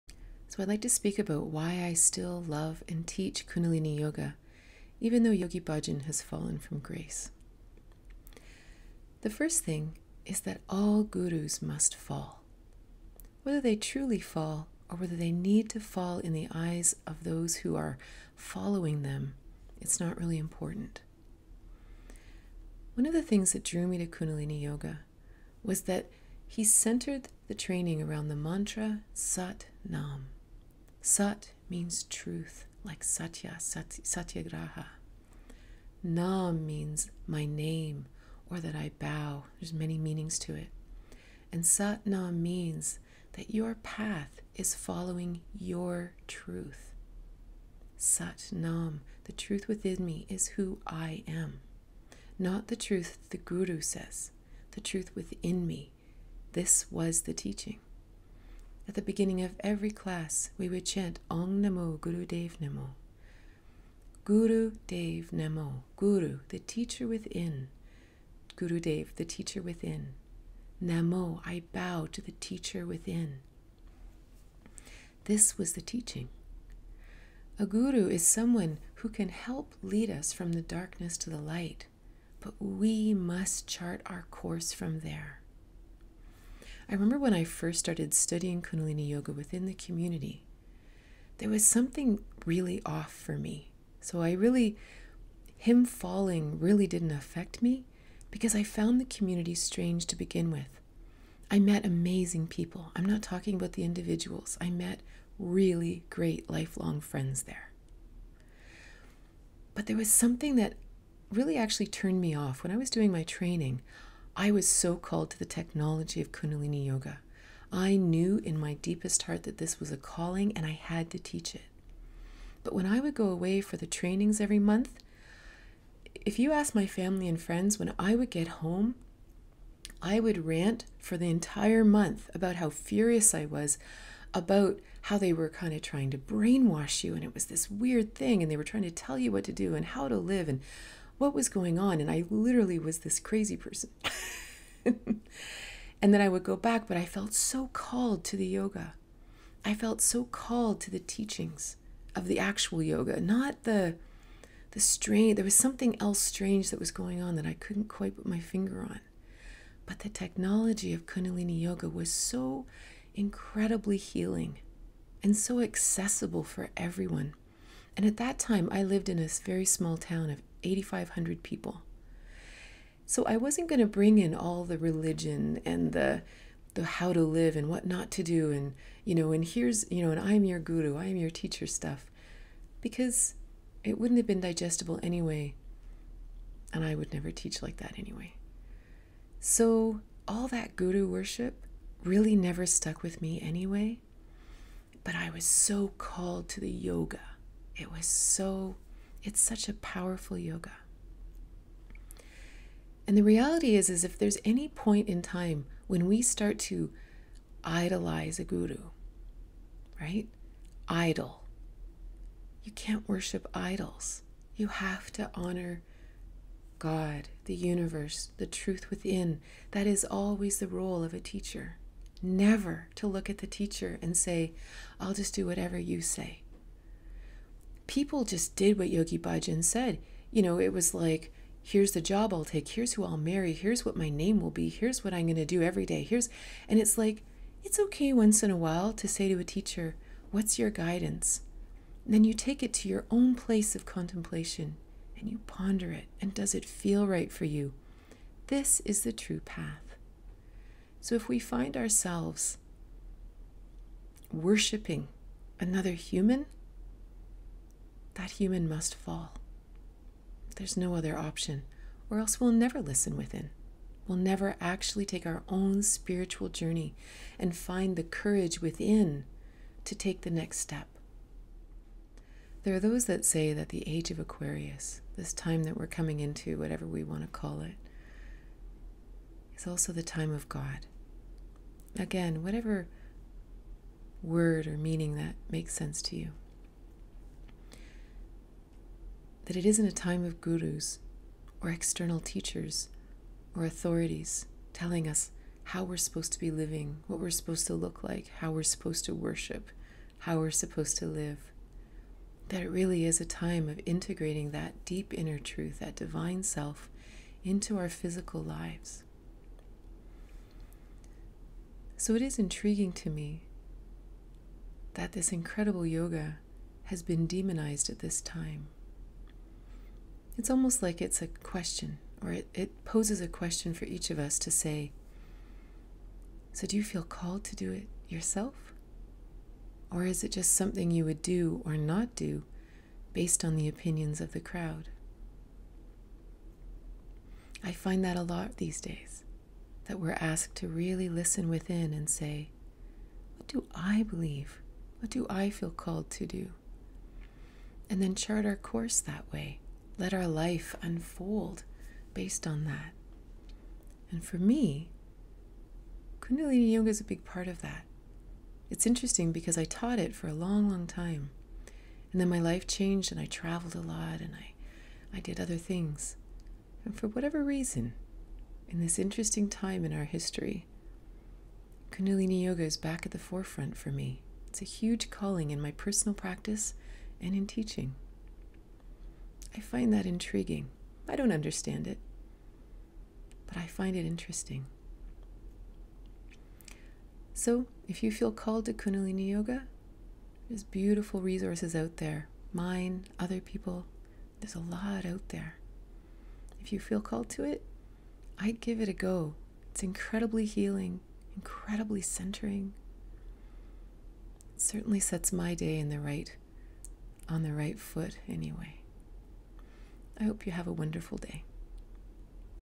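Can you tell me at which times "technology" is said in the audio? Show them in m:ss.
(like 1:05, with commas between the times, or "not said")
1:55, 2:40.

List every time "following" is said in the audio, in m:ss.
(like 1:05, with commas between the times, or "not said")
0:18, 0:44.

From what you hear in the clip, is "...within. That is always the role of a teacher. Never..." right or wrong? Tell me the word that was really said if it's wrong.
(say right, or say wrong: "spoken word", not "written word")
right.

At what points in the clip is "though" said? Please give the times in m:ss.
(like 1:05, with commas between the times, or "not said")
0:05.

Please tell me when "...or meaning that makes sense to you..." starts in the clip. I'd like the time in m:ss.
4:44.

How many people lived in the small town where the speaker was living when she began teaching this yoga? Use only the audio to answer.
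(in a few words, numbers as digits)
8500.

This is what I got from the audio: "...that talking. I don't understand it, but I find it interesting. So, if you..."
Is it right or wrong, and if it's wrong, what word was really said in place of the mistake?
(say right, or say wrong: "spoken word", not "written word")
wrong: "intriguing", not "talking".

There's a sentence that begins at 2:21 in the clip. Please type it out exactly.
And I literally was this crazy person.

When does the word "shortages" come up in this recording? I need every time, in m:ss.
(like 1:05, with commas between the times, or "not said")
not said.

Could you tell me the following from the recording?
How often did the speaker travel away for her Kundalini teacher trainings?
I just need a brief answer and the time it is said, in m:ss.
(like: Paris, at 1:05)
every month, at 2:04.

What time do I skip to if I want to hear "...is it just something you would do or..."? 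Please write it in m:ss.
5:30.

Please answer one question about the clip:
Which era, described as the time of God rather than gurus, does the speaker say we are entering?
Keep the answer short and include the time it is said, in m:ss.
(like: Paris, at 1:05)
age of Aquarius, at 4:33.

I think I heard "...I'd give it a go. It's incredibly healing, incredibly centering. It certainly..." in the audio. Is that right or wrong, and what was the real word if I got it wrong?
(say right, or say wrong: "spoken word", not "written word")
right.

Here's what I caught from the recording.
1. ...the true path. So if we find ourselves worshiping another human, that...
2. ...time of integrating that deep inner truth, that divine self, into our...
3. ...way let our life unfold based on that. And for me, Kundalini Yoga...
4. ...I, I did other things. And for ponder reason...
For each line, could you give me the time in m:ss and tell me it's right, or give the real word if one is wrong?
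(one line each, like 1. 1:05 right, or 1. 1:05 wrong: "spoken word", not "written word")
1. 4:09 right
2. 5:03 right
3. 5:49 right
4. 6:04 wrong: "whatever", not "ponder".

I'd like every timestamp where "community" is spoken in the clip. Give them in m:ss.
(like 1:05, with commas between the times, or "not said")
1:29, 1:39.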